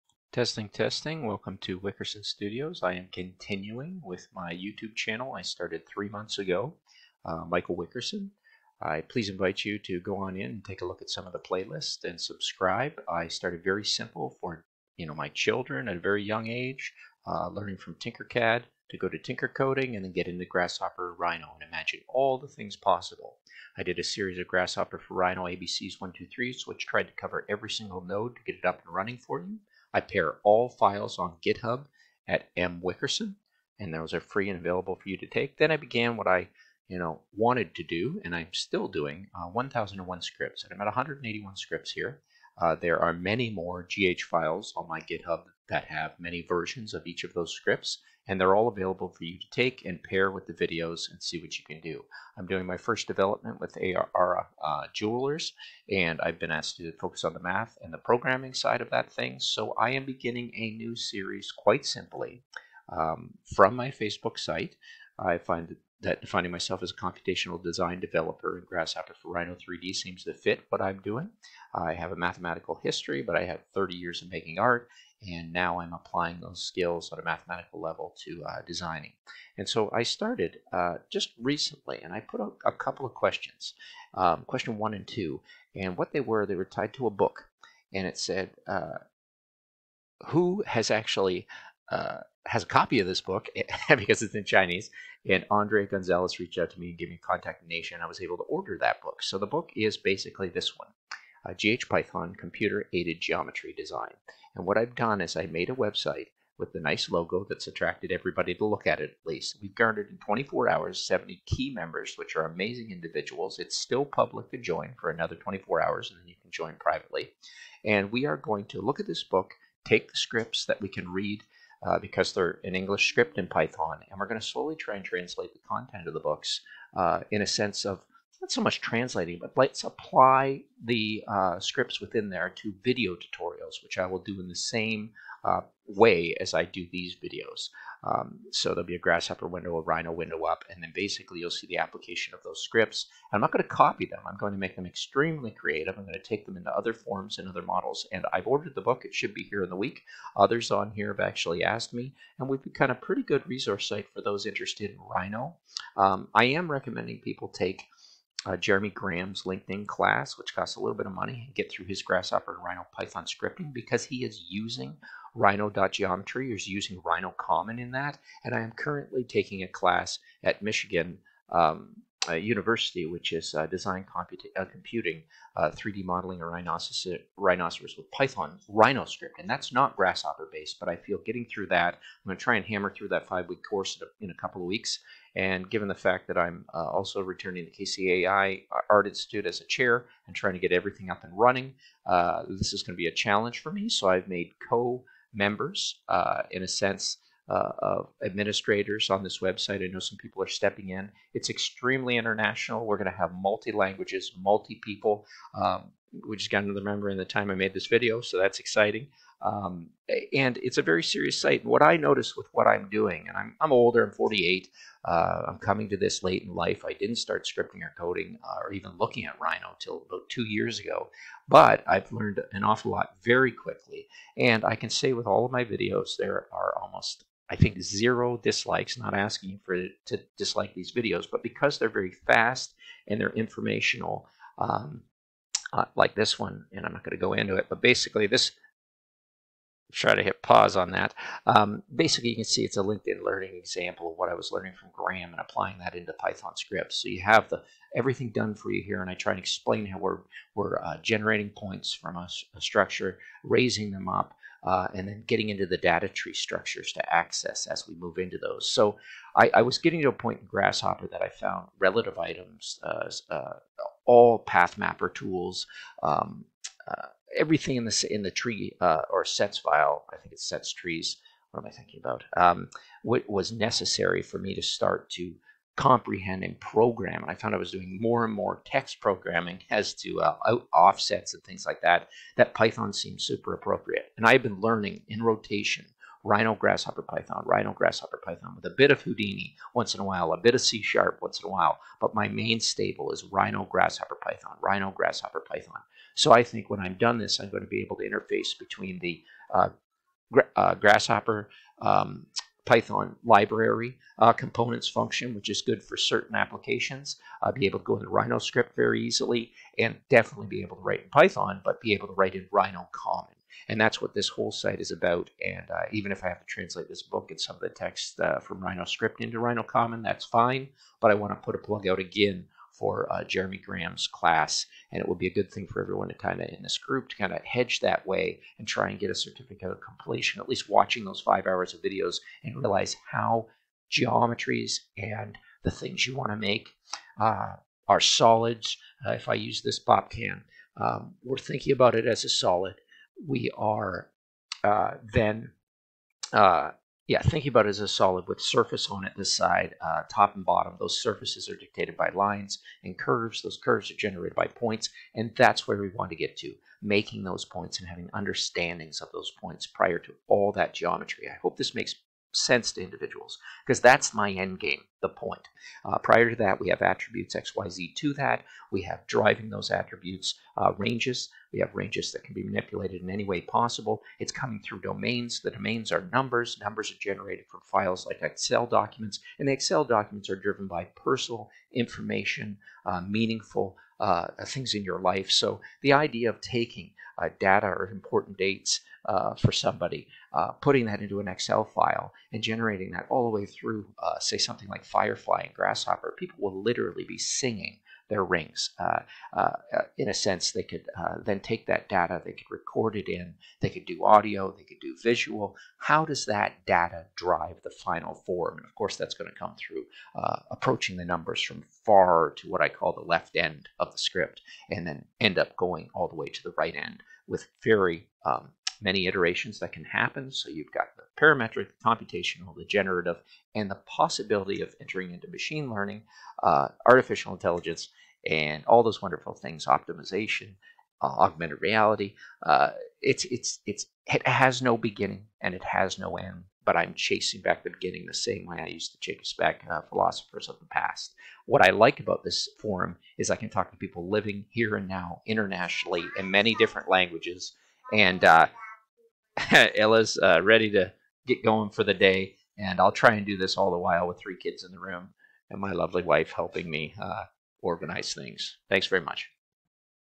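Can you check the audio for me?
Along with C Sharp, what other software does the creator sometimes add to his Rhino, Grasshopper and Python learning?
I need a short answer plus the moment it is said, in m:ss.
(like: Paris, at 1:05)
Houdini, at 4:49.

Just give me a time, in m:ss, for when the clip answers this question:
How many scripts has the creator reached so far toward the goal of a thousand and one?
0:40.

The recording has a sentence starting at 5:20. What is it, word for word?
But I want to put a plug out again for uh, Jeremy Graham's class.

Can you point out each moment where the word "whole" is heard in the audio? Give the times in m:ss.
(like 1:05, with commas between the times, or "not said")
5:14.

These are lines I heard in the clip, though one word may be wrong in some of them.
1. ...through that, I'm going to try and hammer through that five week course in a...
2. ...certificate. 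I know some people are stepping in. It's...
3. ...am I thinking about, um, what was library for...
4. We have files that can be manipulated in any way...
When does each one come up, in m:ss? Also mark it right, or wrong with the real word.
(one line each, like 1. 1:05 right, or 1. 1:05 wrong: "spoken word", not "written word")
1. 3:01 right
2. 3:19 wrong: "website", not "certificate"
3. 4:31 wrong: "necessary", not "library"
4. 6:11 wrong: "ranges", not "files".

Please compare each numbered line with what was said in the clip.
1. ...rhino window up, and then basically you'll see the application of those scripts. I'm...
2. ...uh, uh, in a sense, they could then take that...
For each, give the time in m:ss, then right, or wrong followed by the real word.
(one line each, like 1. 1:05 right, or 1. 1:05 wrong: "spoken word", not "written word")
1. 2:19 right
2. 6:39 right.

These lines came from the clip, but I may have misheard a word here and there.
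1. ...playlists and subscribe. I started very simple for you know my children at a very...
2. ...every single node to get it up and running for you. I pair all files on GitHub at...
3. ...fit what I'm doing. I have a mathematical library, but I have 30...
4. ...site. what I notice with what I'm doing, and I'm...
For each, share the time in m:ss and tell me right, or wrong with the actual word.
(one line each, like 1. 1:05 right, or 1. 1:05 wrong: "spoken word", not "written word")
1. 0:11 right
2. 0:27 right
3. 1:10 wrong: "history", not "library"
4. 3:31 right.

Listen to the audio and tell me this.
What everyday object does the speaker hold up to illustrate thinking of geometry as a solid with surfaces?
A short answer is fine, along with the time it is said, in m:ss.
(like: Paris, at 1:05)
pop can, at 5:39.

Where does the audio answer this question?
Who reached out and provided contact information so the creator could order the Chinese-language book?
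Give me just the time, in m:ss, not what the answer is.
1:35.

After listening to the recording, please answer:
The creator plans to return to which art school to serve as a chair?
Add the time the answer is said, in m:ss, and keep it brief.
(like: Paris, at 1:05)
KCAI Art Institute, at 3:07.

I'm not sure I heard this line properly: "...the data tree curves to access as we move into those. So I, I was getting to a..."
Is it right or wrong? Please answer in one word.
wrong.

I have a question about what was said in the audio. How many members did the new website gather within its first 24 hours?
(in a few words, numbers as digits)
70.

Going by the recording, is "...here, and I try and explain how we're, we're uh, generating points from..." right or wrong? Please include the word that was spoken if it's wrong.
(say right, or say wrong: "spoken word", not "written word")
right.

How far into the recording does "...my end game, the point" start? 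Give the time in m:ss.
6:04.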